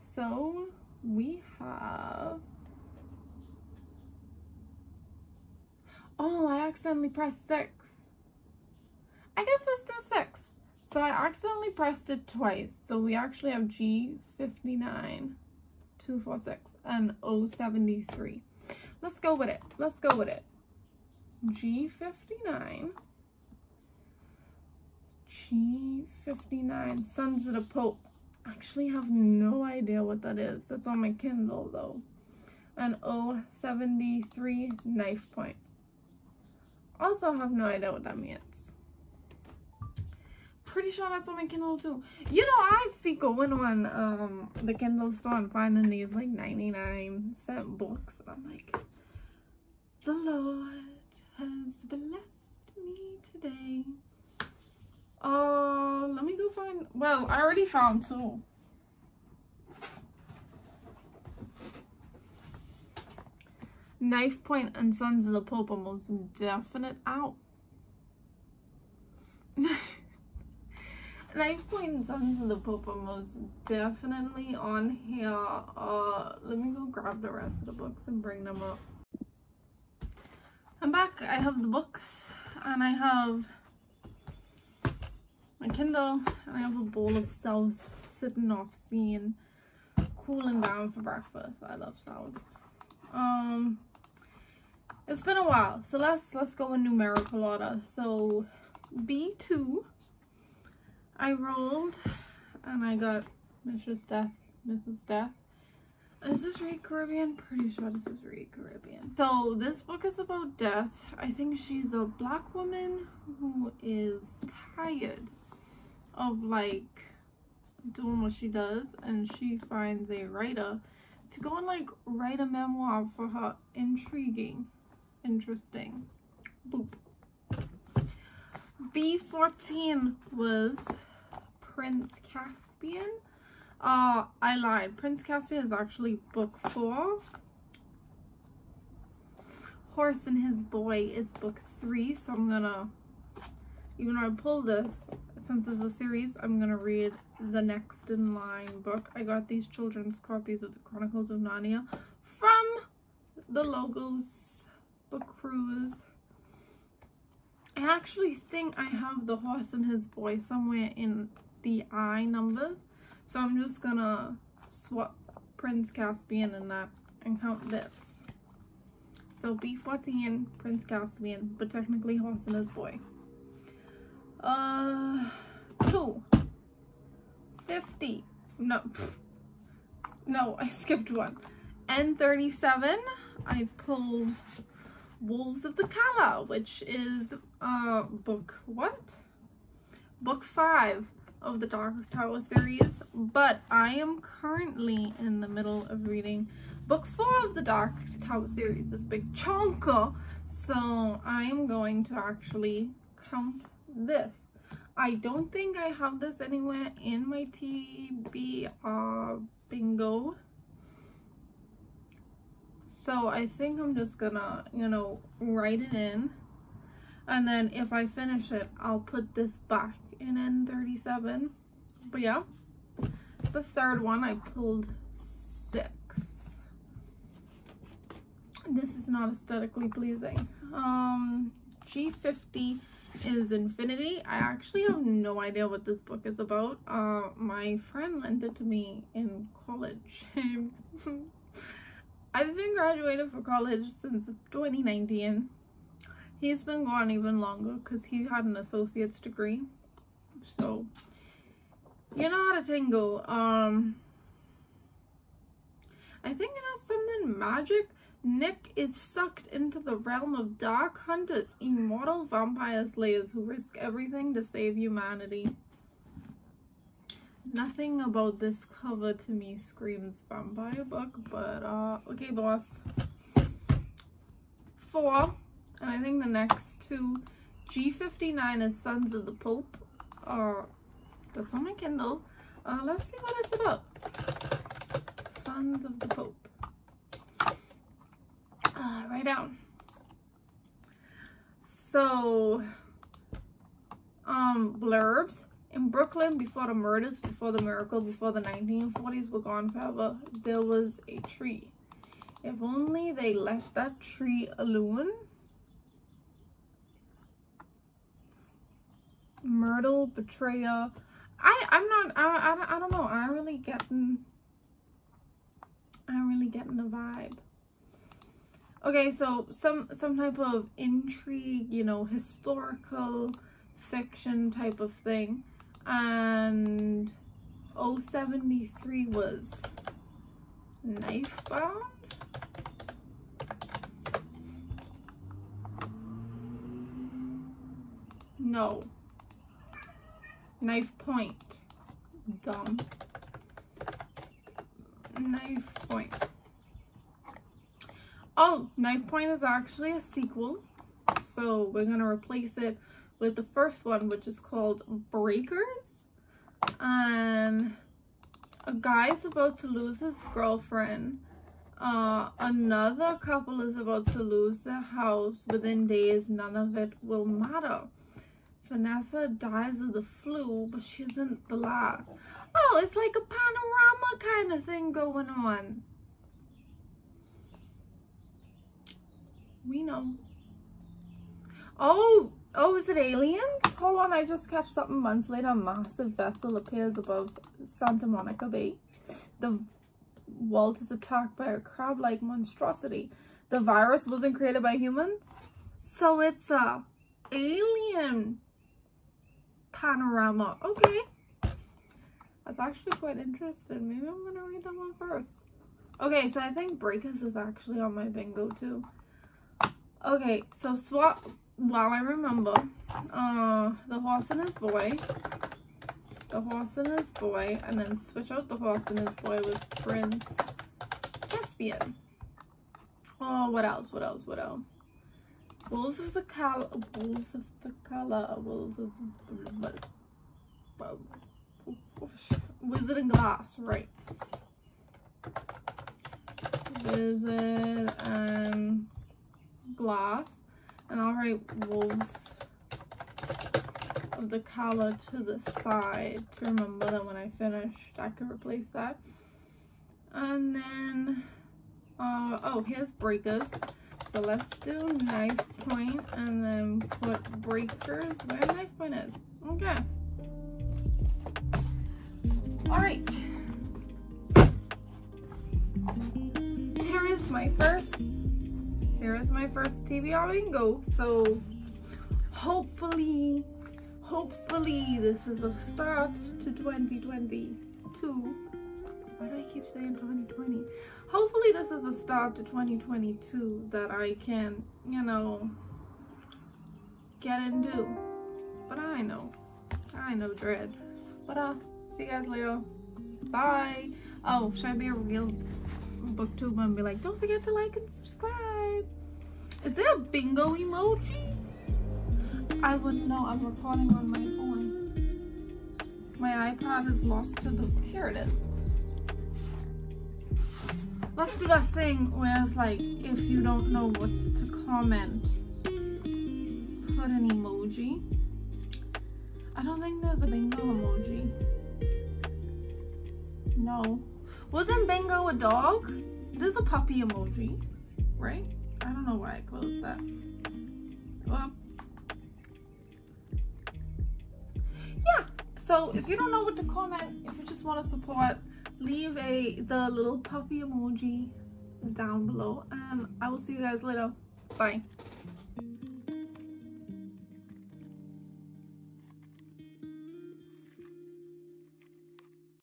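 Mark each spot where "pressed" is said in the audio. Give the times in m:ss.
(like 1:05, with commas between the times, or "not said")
0:07, 0:11.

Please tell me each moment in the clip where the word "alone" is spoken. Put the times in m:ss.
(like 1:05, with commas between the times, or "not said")
5:04.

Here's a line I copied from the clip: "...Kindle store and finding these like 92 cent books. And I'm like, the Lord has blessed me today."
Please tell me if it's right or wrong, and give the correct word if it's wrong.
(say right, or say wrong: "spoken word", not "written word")
wrong: "99", not "92".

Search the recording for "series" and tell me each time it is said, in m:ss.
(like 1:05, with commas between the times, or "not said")
2:25, 3:12, 3:18.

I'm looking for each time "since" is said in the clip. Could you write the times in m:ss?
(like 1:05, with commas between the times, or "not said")
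2:25, 4:03.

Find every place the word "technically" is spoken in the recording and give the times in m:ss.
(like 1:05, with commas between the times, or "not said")
2:51.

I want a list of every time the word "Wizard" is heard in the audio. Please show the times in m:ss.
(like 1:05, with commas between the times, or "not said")
7:12, 7:16.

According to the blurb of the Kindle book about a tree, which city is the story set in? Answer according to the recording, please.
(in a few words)
Brooklyn.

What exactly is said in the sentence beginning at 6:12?
Oh, it's like a panorama kind of thing going on.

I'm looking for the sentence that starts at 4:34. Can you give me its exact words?
Four, and I think the next two, G59 is Sons of the Pope, or that's on my Kindle.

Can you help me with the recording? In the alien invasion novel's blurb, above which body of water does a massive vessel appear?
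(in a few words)
Santa Monica Bay.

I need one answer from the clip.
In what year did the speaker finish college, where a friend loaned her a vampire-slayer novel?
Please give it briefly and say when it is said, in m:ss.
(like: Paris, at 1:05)
2019, at 4:04.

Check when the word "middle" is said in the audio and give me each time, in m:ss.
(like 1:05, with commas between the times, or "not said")
3:15.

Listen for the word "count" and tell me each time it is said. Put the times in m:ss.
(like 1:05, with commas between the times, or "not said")
2:47, 3:23.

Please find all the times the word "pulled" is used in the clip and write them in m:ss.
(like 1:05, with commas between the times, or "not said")
2:24, 3:03, 3:44.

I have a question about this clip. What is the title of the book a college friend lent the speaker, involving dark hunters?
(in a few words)
Infinity.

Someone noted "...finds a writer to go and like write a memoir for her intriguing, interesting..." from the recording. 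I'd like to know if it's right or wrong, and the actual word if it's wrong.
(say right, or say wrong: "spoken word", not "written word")
right.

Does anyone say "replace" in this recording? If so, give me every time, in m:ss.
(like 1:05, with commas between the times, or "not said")
5:52, 7:28.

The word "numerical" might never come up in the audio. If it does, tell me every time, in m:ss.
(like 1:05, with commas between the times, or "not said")
1:36.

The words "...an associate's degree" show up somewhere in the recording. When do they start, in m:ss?
4:08.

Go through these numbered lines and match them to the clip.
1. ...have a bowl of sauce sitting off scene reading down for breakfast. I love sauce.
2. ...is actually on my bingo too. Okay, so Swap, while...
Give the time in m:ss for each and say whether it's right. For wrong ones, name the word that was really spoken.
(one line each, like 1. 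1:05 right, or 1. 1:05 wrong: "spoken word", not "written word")
1. 1:26 wrong: "cooling", not "reading"
2. 6:47 right.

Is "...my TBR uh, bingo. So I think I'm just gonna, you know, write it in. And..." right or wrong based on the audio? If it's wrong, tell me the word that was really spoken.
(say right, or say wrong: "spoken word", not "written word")
right.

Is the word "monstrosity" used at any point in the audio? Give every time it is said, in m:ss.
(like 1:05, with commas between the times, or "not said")
6:32.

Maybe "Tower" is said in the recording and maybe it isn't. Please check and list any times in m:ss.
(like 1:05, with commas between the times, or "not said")
3:12, 3:18.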